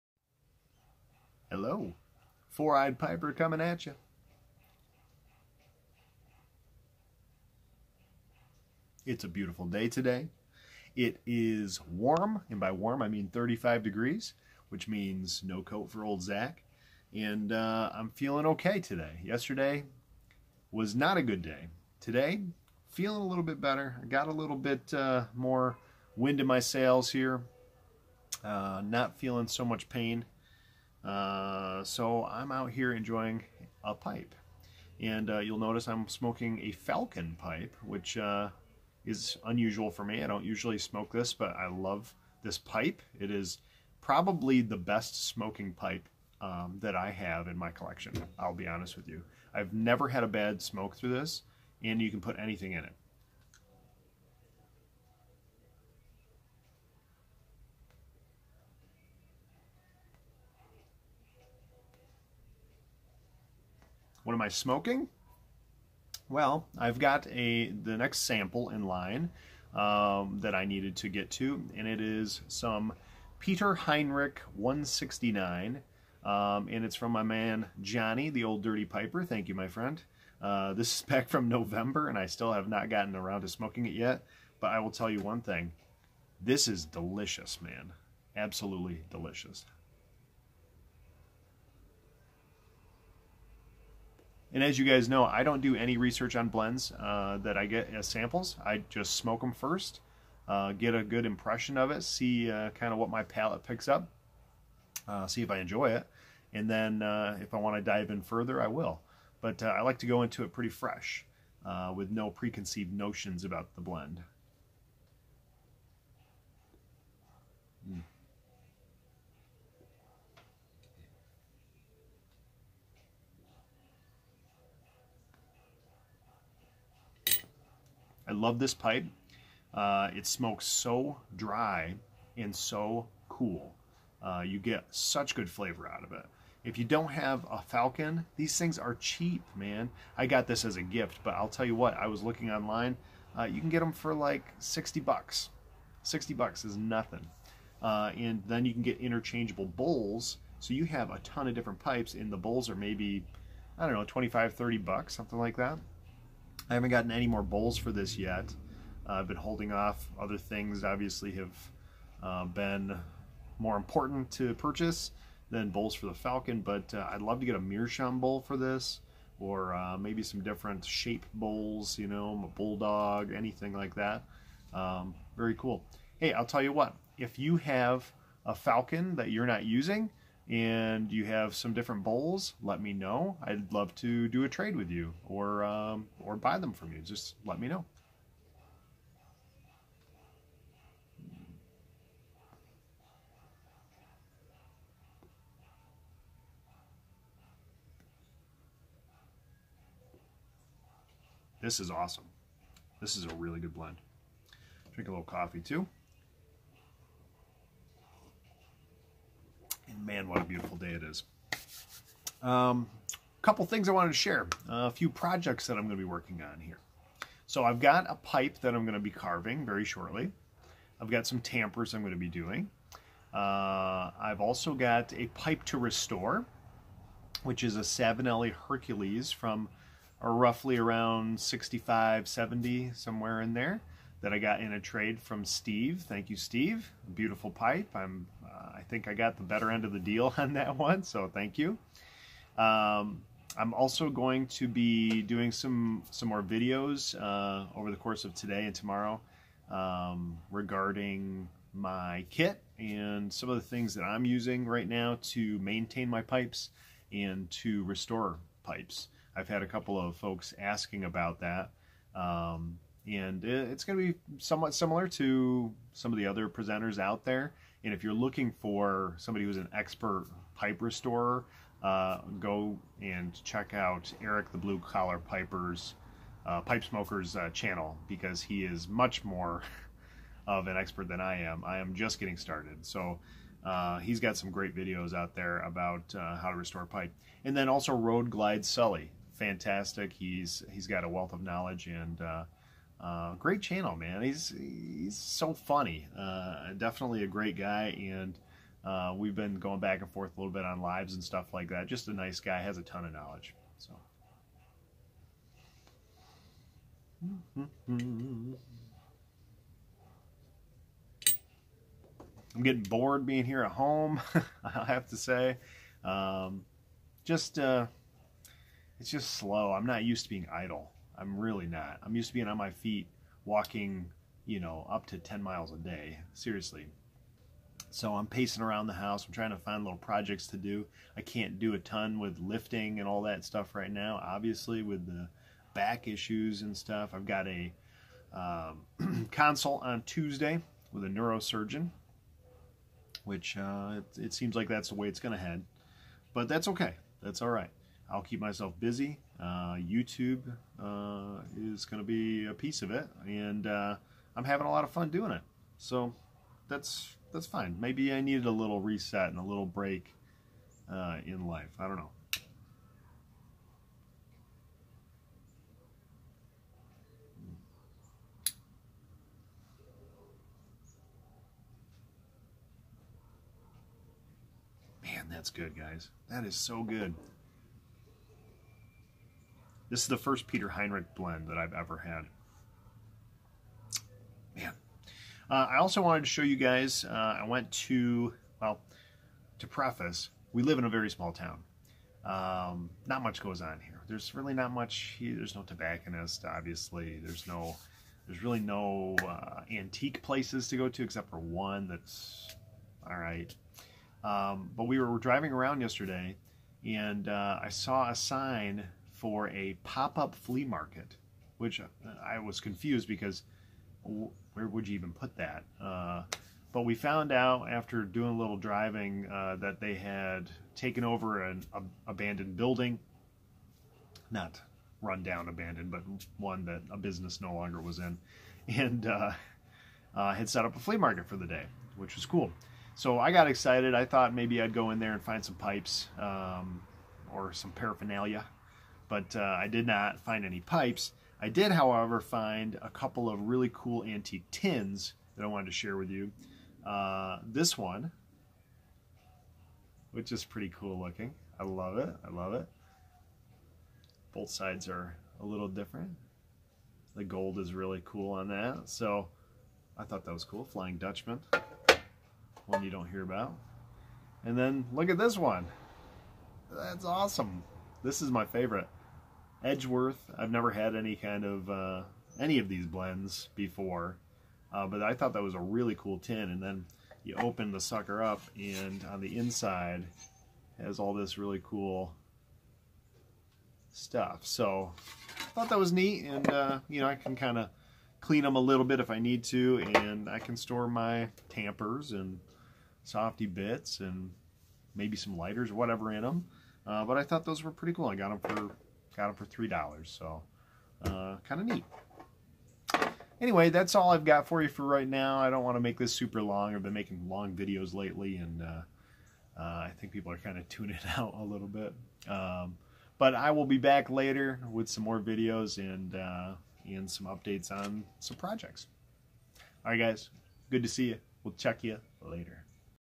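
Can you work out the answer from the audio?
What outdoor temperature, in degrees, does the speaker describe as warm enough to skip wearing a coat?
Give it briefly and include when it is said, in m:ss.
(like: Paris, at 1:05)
35, at 0:13.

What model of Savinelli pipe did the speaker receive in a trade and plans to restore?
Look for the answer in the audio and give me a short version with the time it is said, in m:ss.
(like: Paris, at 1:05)
Hercules, at 3:47.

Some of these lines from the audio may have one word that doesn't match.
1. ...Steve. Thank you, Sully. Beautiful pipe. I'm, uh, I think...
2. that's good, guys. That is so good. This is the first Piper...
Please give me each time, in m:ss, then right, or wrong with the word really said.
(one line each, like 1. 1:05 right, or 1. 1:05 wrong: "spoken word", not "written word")
1. 3:55 wrong: "Steve", not "Sully"
2. 6:15 wrong: "Peter", not "Piper".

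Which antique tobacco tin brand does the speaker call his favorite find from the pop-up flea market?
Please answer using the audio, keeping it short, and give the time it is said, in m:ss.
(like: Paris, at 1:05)
Edgeworth, at 7:49.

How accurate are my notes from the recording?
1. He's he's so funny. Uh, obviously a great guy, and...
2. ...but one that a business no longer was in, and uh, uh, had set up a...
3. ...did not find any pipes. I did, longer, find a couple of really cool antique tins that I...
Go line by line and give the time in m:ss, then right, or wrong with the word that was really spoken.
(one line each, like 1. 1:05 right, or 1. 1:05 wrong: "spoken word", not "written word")
1. 4:54 wrong: "definitely", not "obviously"
2. 7:05 right
3. 7:19 wrong: "however", not "longer".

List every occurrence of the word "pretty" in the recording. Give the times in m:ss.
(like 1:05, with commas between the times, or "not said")
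1:50, 7:30, 8:17.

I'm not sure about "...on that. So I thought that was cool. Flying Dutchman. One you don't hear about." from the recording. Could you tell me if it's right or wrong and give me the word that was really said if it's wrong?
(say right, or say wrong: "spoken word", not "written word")
right.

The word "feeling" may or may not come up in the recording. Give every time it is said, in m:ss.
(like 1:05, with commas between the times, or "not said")
0:18, 0:22, 0:29.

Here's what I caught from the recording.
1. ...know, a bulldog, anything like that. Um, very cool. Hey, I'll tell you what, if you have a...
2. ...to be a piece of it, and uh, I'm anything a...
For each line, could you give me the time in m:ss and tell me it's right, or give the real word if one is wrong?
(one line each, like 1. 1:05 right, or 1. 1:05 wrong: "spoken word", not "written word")
1. 2:52 right
2. 5:52 wrong: "having", not "anything".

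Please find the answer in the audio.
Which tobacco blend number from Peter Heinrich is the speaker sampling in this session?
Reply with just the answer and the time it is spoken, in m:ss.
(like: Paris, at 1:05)
169, at 1:14.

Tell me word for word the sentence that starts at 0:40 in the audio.
I don't usually smoke this, but I love this pipe.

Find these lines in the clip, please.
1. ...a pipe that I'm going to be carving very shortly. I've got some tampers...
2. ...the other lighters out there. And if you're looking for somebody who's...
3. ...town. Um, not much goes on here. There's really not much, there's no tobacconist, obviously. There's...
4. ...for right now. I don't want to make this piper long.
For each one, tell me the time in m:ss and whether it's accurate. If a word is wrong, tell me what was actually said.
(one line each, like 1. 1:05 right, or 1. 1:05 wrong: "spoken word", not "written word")
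1. 3:38 right
2. 4:26 wrong: "presenters", not "lighters"
3. 6:31 right
4. 8:24 wrong: "super", not "piper".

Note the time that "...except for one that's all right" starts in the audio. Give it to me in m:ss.
6:41.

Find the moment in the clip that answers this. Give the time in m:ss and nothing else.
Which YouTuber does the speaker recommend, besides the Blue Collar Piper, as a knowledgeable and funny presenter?
4:47.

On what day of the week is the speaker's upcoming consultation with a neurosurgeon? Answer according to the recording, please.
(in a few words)
Tuesday.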